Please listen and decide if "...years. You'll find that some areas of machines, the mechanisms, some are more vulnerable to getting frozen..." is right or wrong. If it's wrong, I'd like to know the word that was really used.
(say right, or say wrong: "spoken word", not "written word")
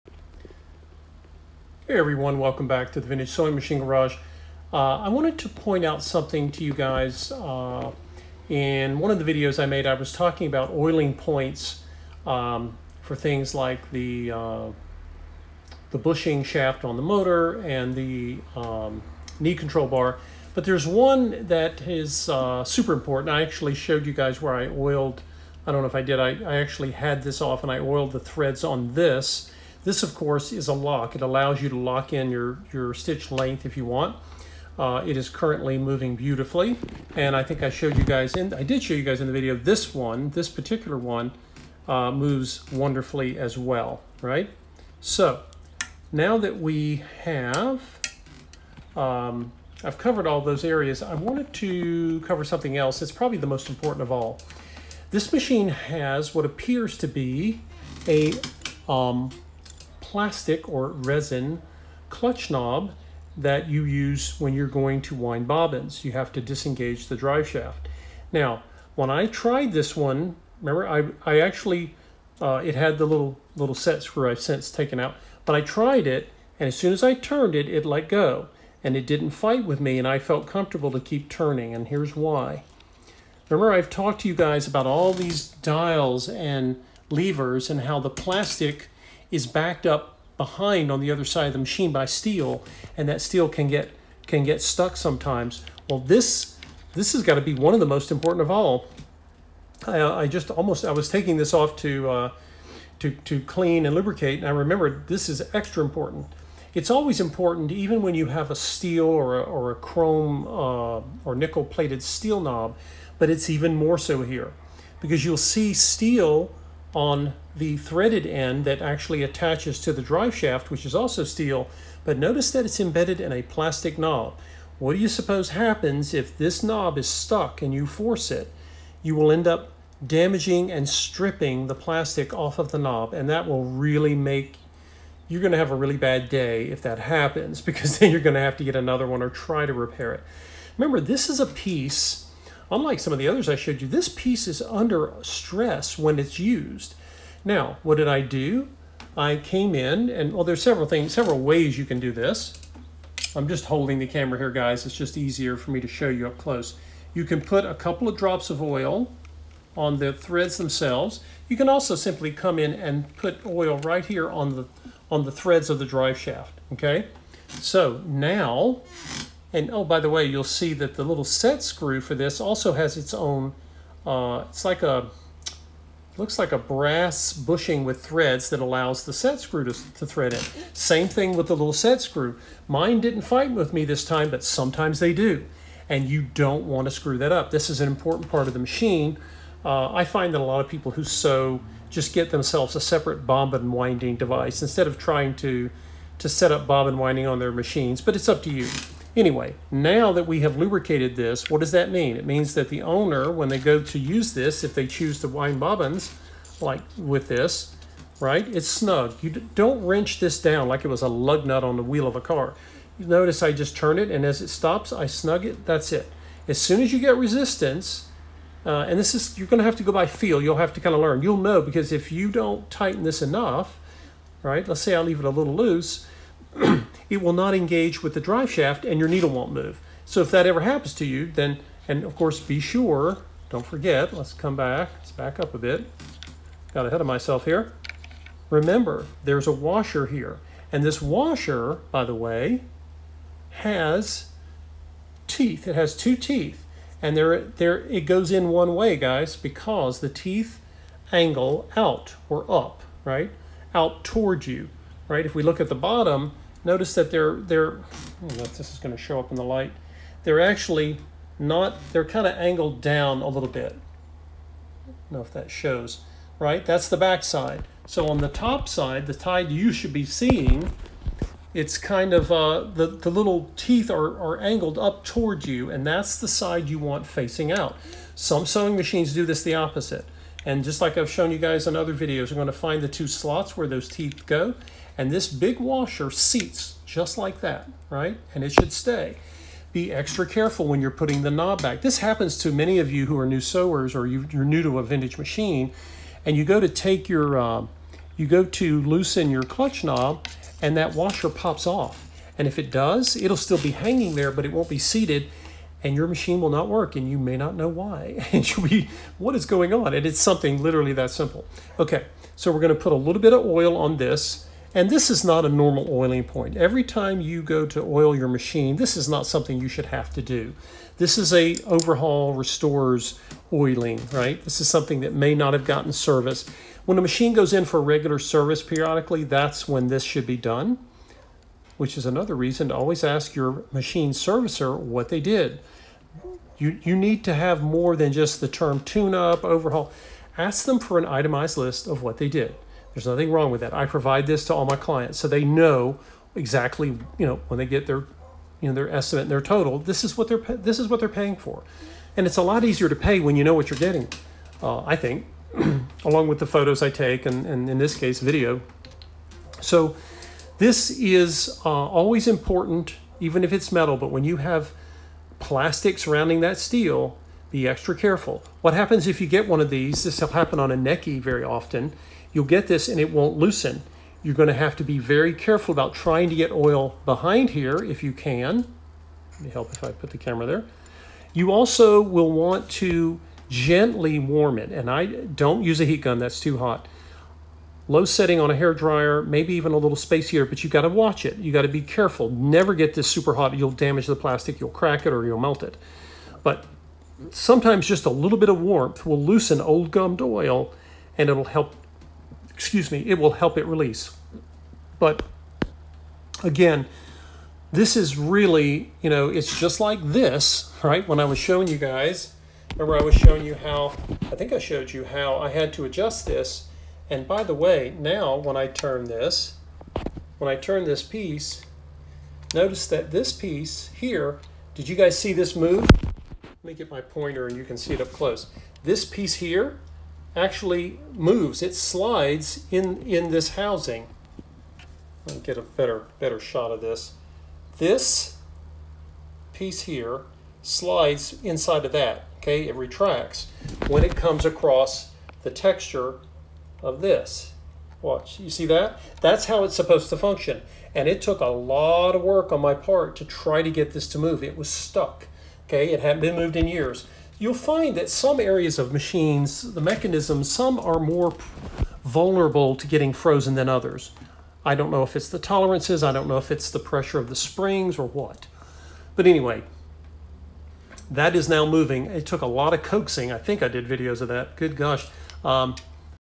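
right.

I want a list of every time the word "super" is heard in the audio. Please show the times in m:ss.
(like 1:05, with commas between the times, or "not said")
0:22, 6:33.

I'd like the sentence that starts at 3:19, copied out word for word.
Anyway, now that we have lubricated this, what does that mean?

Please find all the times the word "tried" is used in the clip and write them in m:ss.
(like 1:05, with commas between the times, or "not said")
1:09, 1:15.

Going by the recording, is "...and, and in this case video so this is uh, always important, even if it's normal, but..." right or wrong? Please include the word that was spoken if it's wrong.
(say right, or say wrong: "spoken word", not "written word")
wrong: "metal", not "normal".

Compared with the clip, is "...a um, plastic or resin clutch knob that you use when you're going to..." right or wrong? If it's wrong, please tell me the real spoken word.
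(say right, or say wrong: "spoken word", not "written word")
right.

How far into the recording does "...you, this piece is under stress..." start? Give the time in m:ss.
2:23.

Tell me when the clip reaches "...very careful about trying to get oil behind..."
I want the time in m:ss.
6:14.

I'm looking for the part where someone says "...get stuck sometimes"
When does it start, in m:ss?
1:34.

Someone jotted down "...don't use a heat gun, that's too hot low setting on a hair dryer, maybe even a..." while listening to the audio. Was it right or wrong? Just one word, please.
right.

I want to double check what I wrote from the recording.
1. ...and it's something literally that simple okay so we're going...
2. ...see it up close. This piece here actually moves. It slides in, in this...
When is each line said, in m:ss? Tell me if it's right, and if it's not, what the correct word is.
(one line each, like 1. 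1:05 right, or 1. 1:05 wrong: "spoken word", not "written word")
1. 5:09 right
2. 7:07 right.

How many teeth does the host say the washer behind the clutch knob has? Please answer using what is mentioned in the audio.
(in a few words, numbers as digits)
2.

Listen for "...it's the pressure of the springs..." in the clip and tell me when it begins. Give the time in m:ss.
7:46.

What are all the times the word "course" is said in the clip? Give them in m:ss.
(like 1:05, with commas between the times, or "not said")
0:30, 3:52.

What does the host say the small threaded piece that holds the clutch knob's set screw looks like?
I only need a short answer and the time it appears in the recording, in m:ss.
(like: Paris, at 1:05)
brass bushing, at 2:56.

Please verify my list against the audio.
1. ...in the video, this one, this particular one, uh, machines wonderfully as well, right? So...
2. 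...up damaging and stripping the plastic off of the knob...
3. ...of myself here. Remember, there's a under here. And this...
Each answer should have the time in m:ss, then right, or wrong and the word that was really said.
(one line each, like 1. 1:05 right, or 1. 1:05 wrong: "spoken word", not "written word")
1. 0:39 wrong: "moves", not "machines"
2. 2:09 right
3. 3:57 wrong: "washer", not "under".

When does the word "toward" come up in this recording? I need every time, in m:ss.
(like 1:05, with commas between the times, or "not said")
4:14, 4:35.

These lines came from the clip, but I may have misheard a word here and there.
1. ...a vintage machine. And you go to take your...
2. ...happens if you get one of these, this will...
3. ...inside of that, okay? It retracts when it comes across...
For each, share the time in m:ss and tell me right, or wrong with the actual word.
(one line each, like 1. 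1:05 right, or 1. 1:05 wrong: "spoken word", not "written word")
1. 4:54 right
2. 6:08 right
3. 7:21 right.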